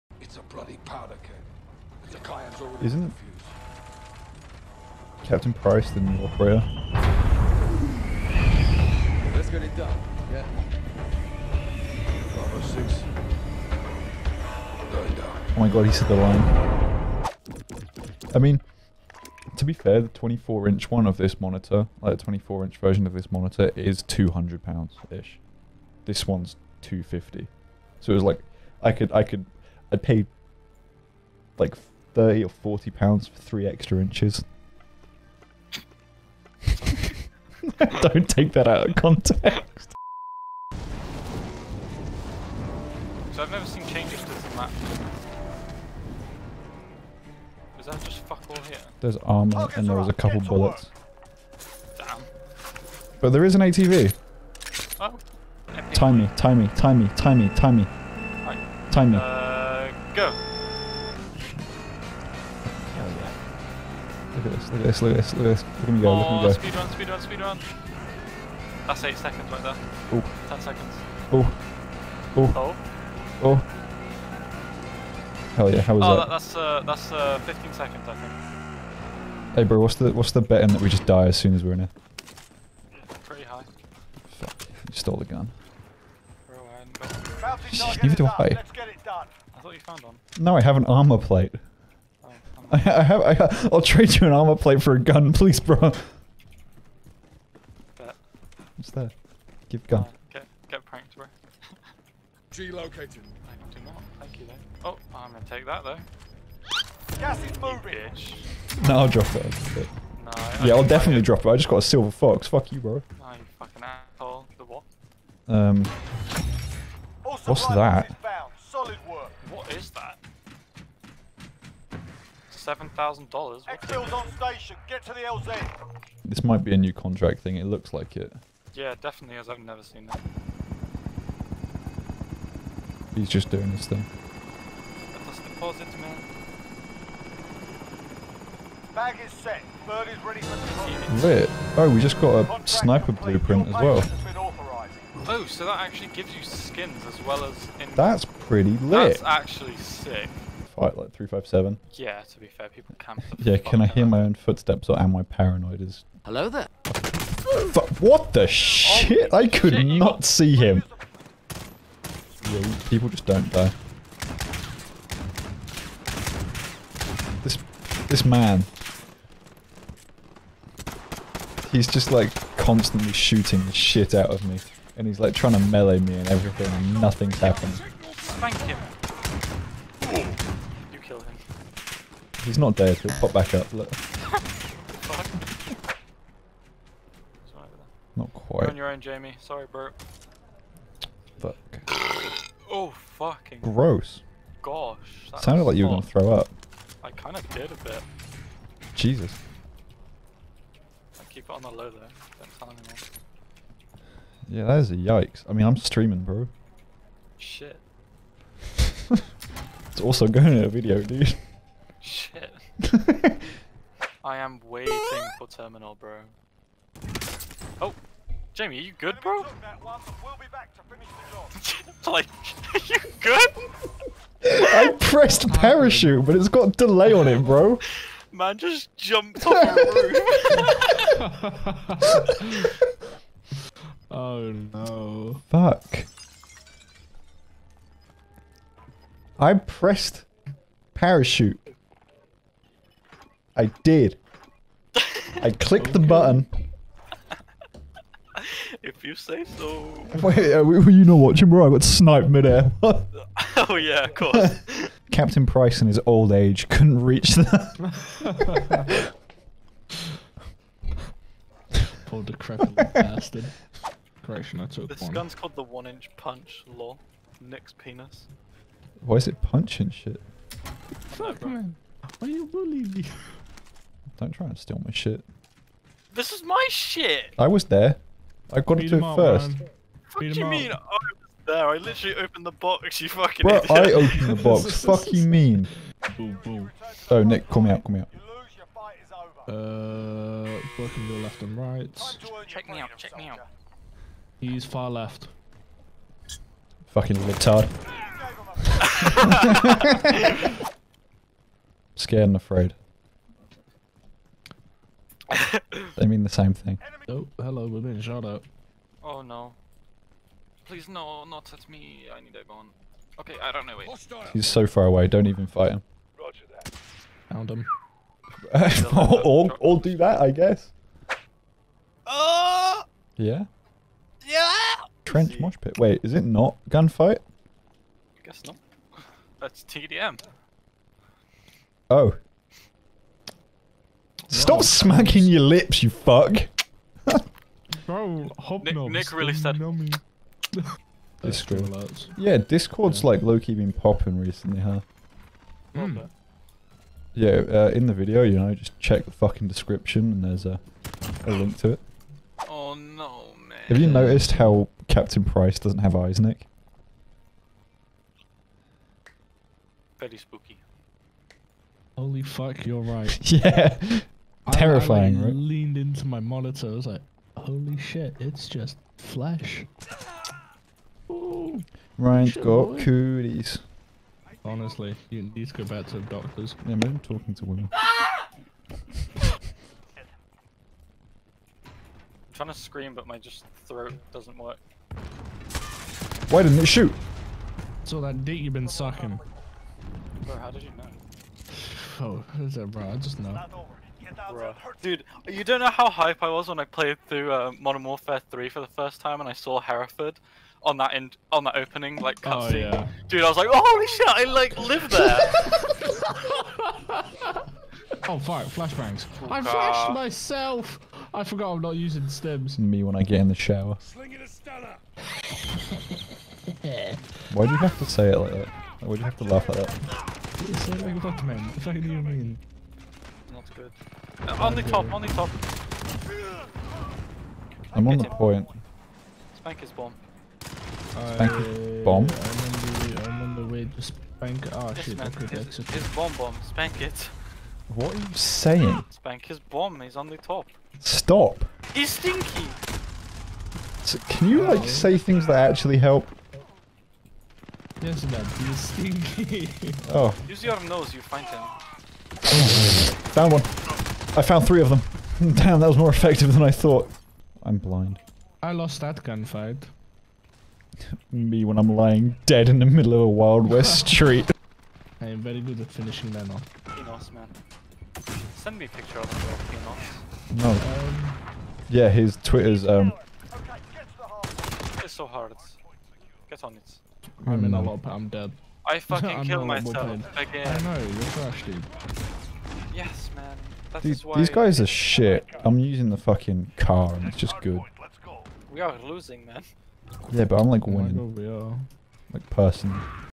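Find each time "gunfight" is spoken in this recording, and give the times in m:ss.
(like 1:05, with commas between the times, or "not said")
5:26, 7:39.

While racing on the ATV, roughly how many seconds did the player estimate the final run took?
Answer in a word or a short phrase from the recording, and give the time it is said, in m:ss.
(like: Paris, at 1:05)
15 seconds, at 1:17.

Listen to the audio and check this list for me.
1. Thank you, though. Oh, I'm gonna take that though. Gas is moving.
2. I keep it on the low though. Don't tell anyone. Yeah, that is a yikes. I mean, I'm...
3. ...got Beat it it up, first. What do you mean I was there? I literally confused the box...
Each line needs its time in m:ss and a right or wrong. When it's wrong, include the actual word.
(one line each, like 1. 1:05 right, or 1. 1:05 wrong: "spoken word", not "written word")
1. 1:44 right
2. 3:21 right
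3. 4:38 wrong: "opened", not "confused".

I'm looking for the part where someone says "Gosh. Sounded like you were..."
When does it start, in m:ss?
3:14.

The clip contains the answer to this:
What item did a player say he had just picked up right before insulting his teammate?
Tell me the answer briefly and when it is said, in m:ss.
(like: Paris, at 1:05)
A silver fox, at 1:51.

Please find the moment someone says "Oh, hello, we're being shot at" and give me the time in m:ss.
5:07.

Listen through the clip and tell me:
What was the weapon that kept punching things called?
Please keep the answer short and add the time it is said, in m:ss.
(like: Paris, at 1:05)
The one-inch punch, at 4:25.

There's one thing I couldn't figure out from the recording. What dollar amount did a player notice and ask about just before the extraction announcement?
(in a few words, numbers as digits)
$7,000.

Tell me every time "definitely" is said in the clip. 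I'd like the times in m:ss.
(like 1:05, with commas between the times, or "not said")
1:50, 2:09.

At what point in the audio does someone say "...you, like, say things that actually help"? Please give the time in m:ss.
7:24.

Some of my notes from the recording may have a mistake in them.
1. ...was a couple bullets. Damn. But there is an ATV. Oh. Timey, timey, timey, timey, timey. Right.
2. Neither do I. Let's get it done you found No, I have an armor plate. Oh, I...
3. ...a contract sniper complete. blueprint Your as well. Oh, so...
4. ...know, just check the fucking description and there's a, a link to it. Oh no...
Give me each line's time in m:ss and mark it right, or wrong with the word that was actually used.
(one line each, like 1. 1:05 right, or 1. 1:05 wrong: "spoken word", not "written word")
1. 0:49 right
2. 1:28 right
3. 2:22 right
4. 5:48 right.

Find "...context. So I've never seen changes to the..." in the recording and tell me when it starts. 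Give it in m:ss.
0:38.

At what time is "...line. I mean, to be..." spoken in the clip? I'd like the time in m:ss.
0:16.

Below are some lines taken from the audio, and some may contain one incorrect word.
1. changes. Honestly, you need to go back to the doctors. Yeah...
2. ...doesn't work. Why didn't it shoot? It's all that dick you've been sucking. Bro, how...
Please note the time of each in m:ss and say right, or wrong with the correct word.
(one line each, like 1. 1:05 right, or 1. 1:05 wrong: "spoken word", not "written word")
1. 6:12 wrong: "cooties", not "changes"
2. 6:24 right.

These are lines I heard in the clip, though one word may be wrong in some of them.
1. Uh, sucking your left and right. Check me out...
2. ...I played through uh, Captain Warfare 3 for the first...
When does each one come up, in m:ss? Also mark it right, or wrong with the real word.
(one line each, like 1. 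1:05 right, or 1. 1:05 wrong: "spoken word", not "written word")
1. 4:49 wrong: "working", not "sucking"
2. 6:36 wrong: "Modern", not "Captain".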